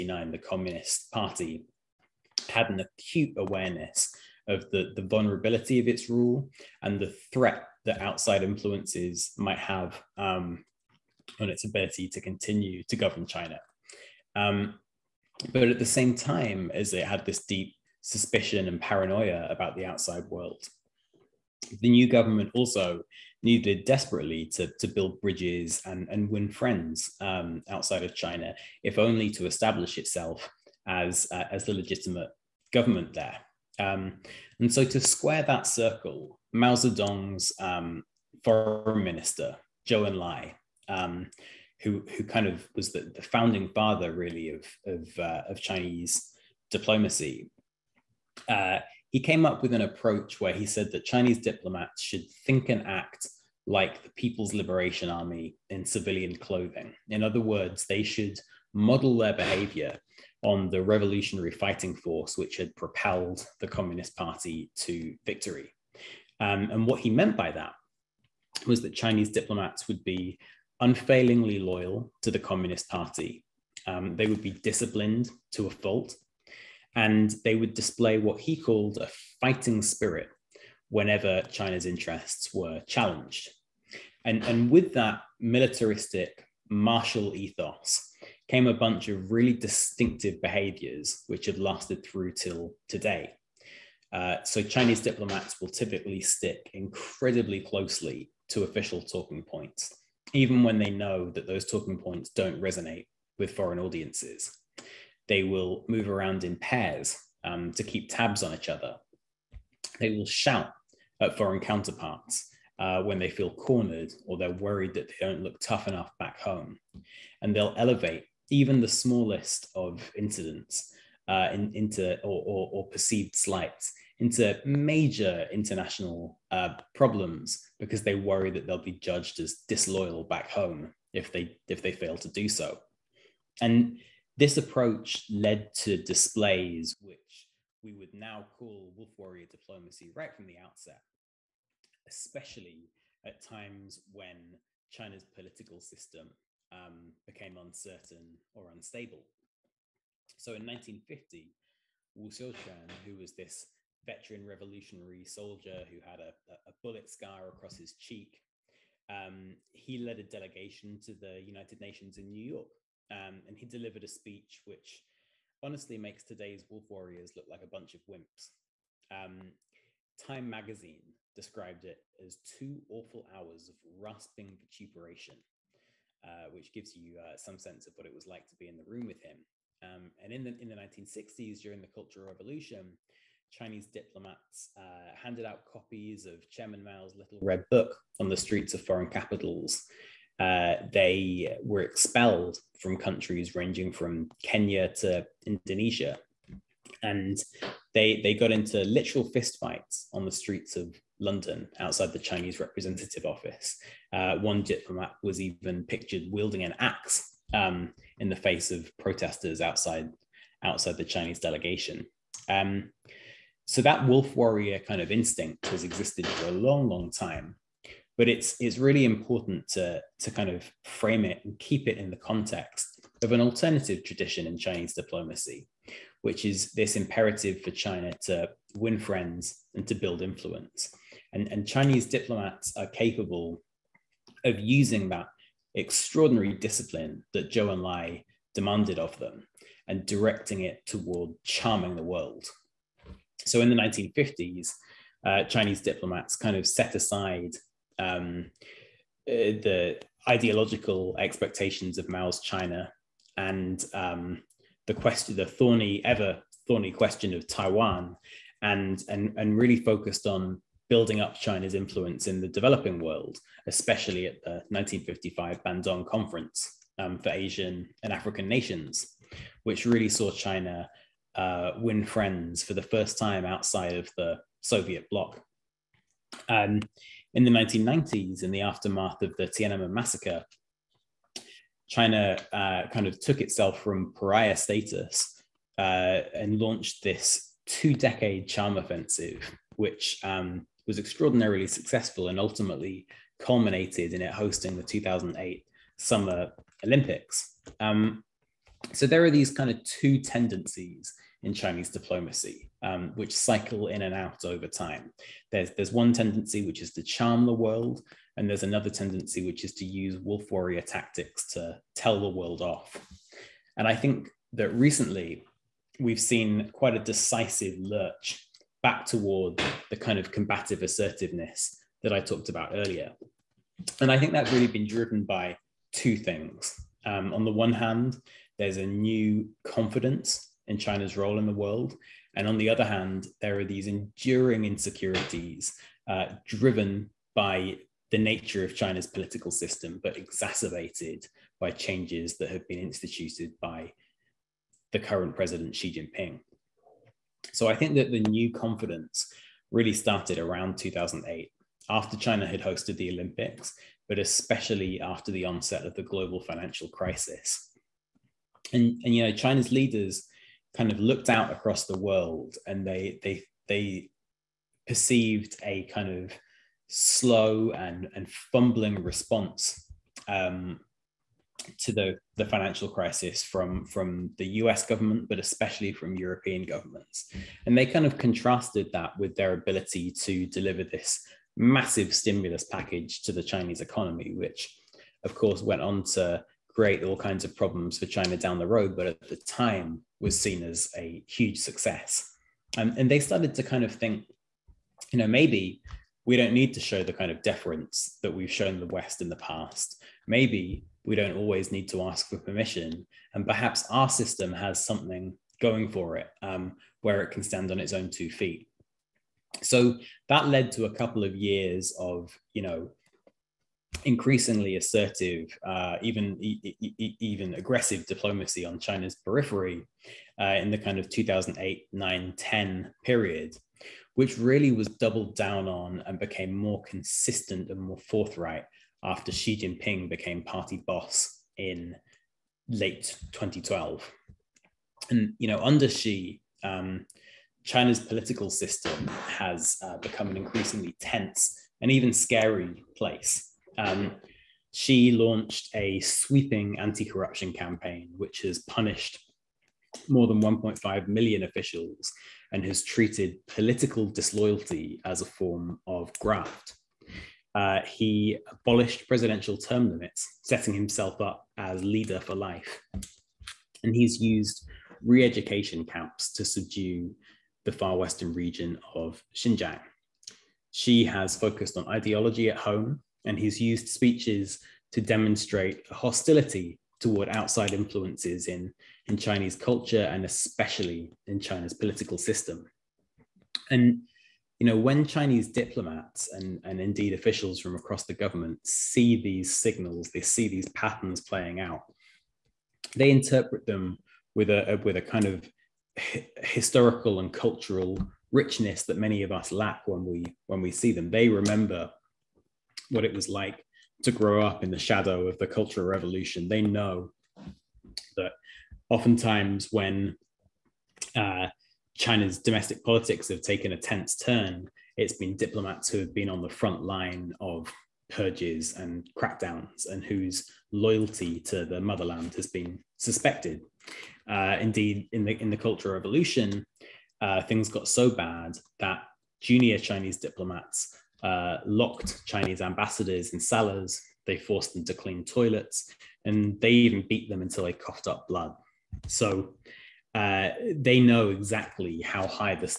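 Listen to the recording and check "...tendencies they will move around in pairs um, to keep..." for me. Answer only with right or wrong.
wrong.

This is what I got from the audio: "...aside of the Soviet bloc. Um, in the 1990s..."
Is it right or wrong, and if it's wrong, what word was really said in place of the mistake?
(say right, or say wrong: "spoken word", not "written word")
wrong: "outside", not "aside".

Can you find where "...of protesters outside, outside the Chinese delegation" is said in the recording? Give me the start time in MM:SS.
03:28.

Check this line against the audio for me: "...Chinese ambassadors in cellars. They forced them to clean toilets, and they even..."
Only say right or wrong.
right.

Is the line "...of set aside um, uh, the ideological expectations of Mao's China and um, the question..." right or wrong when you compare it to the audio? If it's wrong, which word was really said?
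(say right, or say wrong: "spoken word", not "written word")
right.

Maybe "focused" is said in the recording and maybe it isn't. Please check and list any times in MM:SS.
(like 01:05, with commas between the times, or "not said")
04:19, 07:51.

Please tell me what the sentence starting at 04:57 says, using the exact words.
Um, so there are these kind of two tendencies in Chinese diplomacy, um, which cycle in and out over time.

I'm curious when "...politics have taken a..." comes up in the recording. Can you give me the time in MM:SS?
08:32.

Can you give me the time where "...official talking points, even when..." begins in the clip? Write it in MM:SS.
01:38.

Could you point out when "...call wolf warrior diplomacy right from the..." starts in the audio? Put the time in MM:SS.
02:18.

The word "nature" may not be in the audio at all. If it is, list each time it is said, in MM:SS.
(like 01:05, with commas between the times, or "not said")
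05:38.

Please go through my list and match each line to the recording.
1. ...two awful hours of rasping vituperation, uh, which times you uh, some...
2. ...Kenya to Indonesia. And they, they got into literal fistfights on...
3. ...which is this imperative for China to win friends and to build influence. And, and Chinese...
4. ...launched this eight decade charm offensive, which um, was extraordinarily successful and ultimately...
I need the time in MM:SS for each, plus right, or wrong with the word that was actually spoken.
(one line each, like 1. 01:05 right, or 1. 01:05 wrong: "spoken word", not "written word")
1. 02:52 wrong: "gives", not "times"
2. 03:14 right
3. 03:46 right
4. 04:46 wrong: "two", not "eight".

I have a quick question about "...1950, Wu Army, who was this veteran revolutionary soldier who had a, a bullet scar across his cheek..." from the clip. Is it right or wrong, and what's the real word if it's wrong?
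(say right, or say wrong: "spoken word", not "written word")
wrong: "Xiuquan", not "Army".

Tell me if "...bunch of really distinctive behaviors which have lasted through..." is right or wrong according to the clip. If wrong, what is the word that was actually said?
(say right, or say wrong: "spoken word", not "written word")
right.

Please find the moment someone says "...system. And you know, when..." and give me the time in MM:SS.
08:02.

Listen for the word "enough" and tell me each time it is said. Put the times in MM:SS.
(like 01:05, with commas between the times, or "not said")
01:55.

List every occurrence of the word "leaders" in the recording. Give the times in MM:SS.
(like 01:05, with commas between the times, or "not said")
05:59, 07:41.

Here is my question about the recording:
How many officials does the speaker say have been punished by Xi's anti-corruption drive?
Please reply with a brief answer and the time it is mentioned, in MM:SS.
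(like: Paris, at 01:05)
More than 1.5 million, at 07:30.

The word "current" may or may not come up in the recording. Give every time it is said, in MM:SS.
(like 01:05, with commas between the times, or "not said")
05:44.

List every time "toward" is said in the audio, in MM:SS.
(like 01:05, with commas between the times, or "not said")
04:00, 05:19, 07:56.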